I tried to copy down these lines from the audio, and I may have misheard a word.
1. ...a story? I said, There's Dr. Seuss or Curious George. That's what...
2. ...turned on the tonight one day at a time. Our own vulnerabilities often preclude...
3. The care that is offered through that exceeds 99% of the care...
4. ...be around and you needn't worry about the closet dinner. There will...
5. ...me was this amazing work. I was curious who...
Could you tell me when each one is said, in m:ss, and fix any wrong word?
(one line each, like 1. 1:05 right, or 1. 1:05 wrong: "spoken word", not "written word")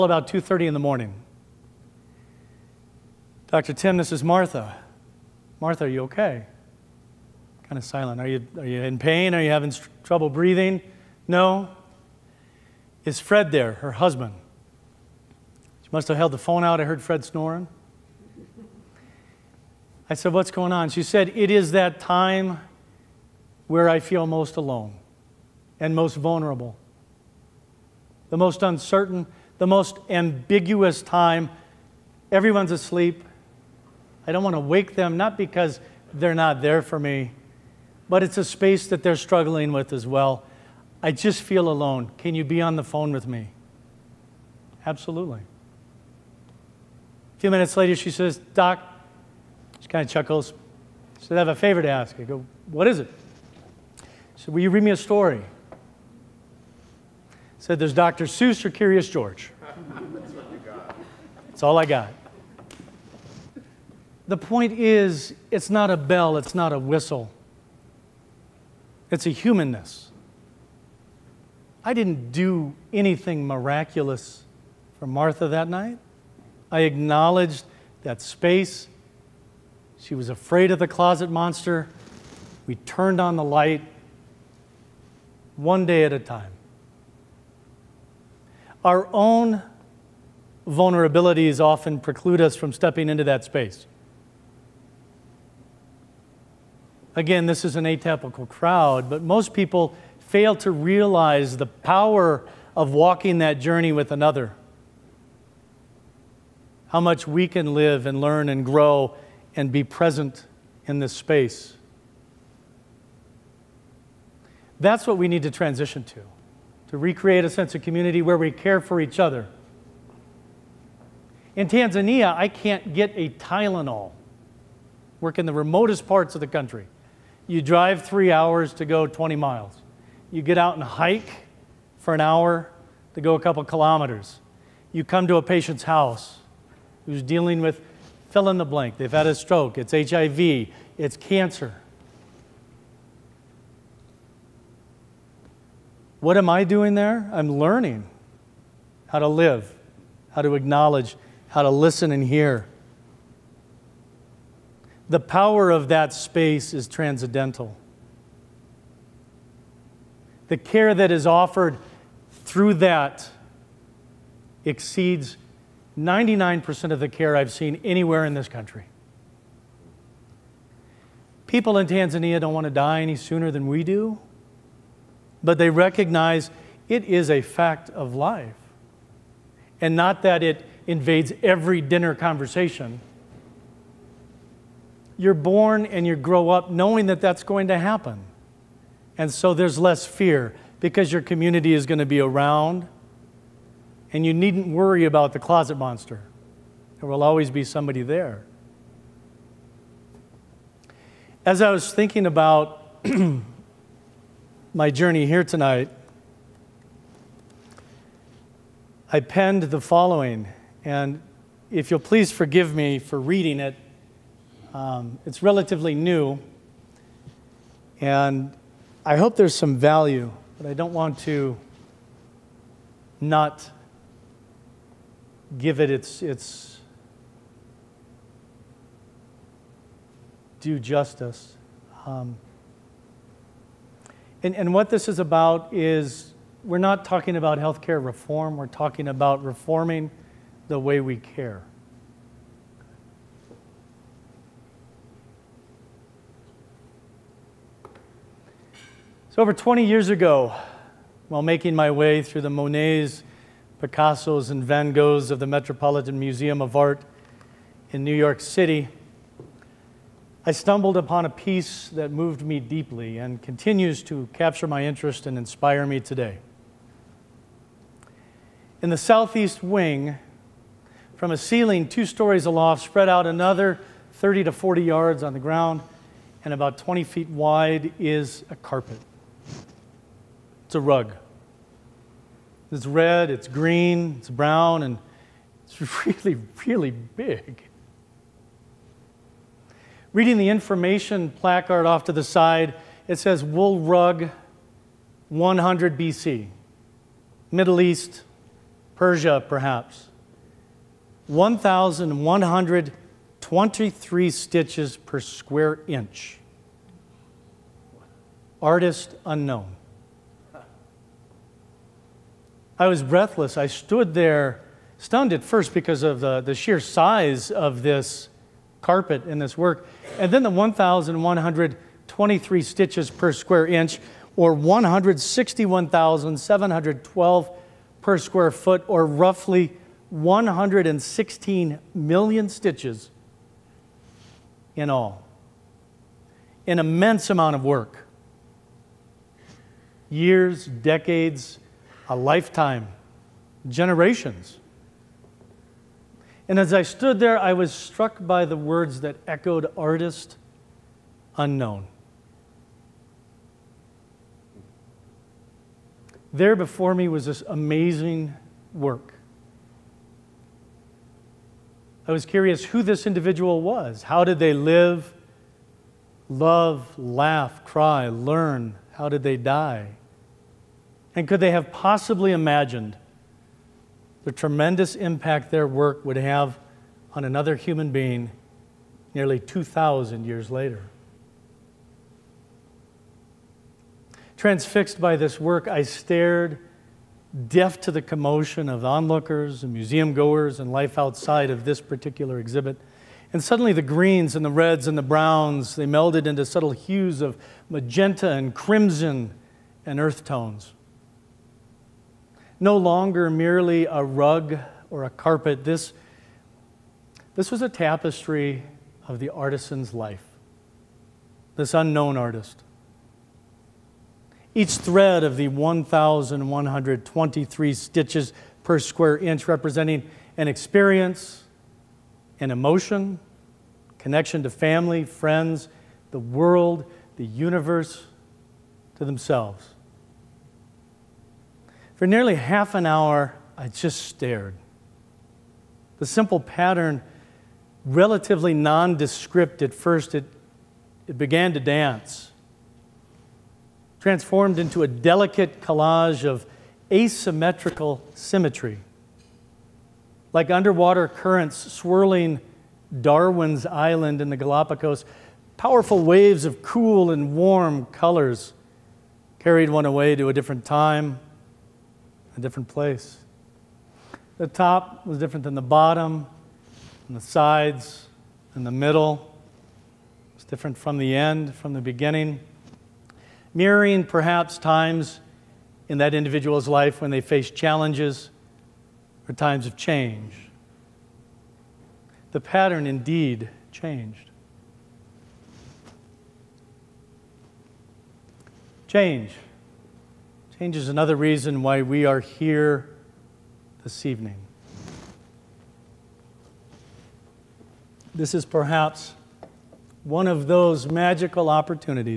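1. 0:54 right
2. 1:22 wrong: "light", not "tonight"
3. 2:40 right
4. 3:12 wrong: "monster", not "dinner"
5. 5:56 right.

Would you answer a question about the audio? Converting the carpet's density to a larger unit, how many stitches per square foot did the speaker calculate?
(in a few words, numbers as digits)
161,712.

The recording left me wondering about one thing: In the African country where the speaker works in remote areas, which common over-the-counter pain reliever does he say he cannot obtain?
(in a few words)
Tylenol.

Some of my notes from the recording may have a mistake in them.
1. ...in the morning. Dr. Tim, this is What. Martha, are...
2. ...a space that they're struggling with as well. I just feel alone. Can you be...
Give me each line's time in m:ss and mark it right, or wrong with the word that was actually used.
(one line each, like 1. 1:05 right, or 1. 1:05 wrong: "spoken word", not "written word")
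1. 0:00 wrong: "Martha", not "What"
2. 0:38 right.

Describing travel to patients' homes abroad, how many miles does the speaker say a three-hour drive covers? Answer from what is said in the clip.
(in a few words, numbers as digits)
20 miles.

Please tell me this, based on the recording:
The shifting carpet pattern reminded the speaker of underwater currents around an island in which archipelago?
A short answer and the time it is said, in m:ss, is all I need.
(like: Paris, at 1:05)
Galapagos, at 7:34.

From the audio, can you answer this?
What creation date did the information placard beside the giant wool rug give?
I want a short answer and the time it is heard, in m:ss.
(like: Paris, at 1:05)
100 BC, at 4:55.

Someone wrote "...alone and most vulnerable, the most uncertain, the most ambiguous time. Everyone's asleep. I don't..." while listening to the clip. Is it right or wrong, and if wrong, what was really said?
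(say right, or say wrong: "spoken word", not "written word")
right.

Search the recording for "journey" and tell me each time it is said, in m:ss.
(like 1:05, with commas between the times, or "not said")
1:43, 3:24.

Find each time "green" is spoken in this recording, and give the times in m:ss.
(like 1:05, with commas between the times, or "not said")
4:43, 6:33.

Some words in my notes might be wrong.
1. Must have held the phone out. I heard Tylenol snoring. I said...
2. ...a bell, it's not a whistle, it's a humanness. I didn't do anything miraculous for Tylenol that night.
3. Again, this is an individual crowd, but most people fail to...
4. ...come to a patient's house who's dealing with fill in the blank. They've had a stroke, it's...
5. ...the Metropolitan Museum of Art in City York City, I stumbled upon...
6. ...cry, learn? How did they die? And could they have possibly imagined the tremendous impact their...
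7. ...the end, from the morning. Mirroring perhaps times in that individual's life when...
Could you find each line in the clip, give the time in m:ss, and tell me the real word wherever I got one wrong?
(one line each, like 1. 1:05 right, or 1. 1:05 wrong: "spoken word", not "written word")
1. 0:15 wrong: "Fred", not "Tylenol"
2. 1:05 wrong: "Martha", not "Tylenol"
3. 1:37 wrong: "atypical", not "individual"
4. 2:15 right
5. 4:15 wrong: "New", not "City"
6. 6:07 right
7. 7:50 wrong: "beginning", not "morning".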